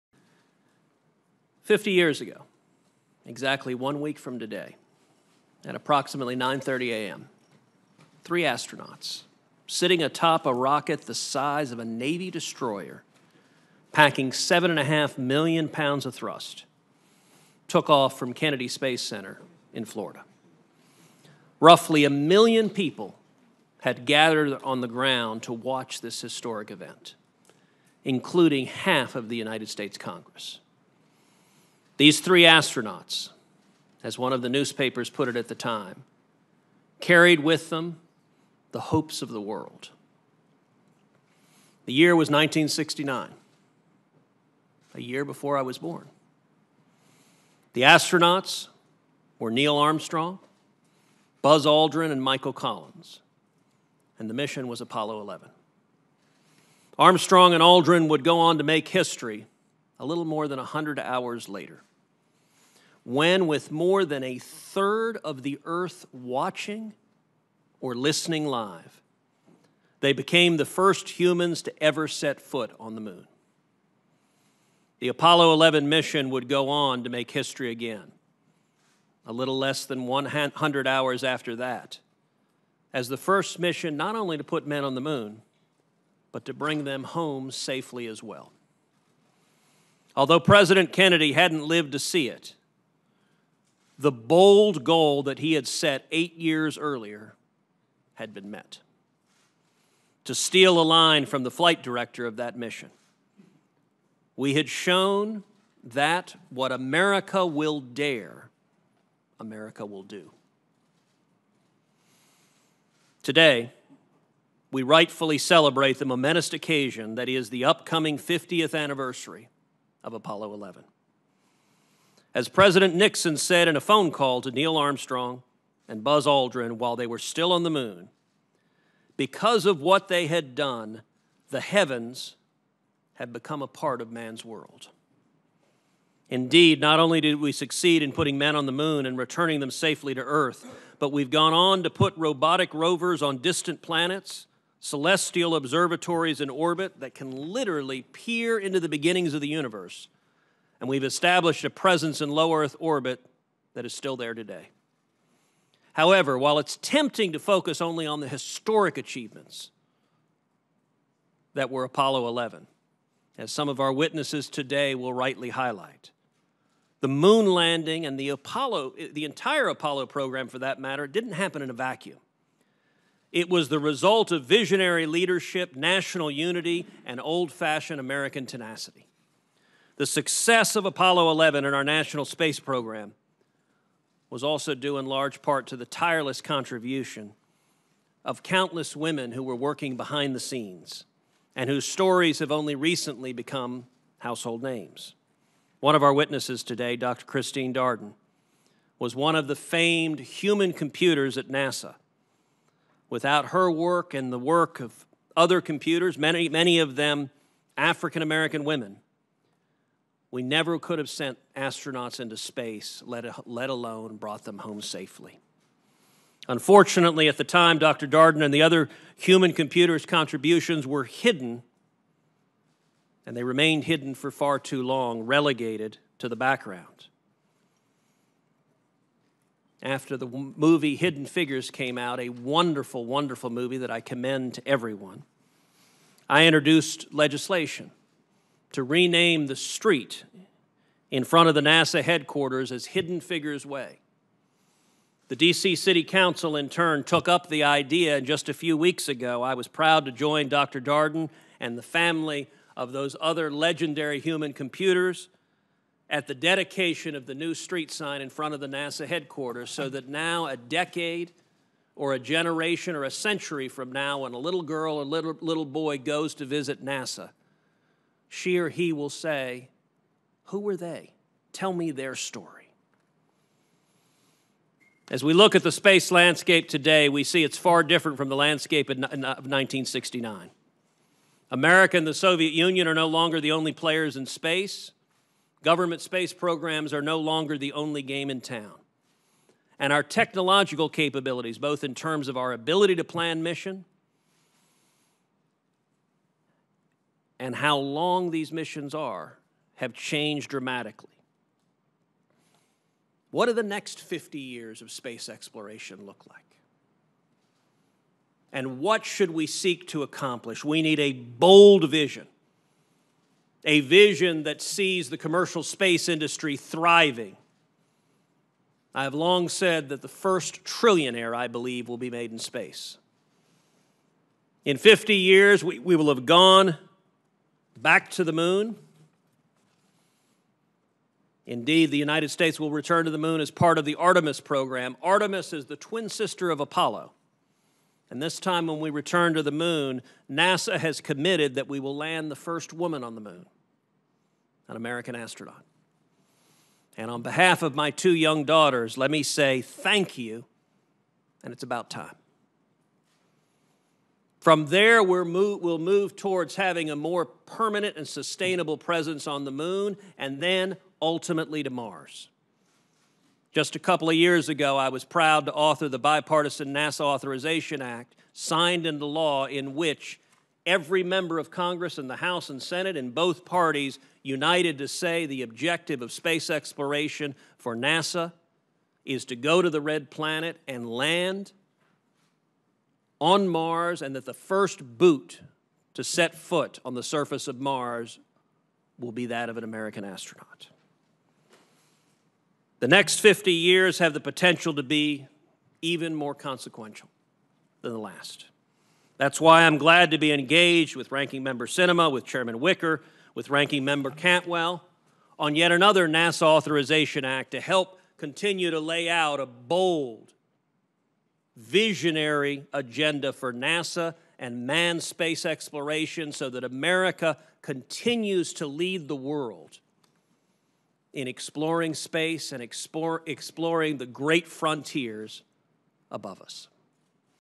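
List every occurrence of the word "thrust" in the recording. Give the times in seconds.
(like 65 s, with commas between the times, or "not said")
16 s.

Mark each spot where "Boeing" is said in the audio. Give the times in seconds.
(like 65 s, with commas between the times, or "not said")
not said.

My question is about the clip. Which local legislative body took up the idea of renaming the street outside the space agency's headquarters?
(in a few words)
DC City Council.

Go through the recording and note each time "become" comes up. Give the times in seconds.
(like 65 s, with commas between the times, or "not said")
133 s, 193 s.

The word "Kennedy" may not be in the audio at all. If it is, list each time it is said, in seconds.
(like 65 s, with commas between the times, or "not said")
18 s, 90 s.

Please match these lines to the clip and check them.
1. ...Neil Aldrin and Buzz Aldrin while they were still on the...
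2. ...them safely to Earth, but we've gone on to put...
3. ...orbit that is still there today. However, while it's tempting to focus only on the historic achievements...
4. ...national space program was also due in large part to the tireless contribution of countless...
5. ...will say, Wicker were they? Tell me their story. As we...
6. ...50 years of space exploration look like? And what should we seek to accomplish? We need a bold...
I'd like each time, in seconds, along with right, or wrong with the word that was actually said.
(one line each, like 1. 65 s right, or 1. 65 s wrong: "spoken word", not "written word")
1. 124 s wrong: "Armstrong", not "Aldrin"
2. 139 s right
3. 152 s right
4. 181 s right
5. 268 s wrong: "Who", not "Wicker"
6. 303 s right.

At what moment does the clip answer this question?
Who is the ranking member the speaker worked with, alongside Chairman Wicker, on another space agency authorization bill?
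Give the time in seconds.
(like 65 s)
401 s.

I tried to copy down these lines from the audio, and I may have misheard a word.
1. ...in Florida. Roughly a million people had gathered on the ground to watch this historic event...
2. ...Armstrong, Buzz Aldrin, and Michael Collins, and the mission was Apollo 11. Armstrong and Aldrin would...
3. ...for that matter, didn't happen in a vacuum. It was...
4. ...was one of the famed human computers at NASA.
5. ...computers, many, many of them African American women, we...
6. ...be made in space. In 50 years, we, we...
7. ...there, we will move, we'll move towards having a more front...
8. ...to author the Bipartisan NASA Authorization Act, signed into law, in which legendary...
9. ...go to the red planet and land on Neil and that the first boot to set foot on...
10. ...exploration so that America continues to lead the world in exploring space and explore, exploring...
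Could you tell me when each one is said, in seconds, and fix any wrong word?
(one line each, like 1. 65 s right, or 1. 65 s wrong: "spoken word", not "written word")
1. 19 s right
2. 49 s right
3. 170 s right
4. 198 s right
5. 205 s right
6. 321 s right
7. 354 s wrong: "permanent", not "front"
8. 365 s wrong: "every", not "legendary"
9. 379 s wrong: "Mars", not "Neil"
10. 415 s right.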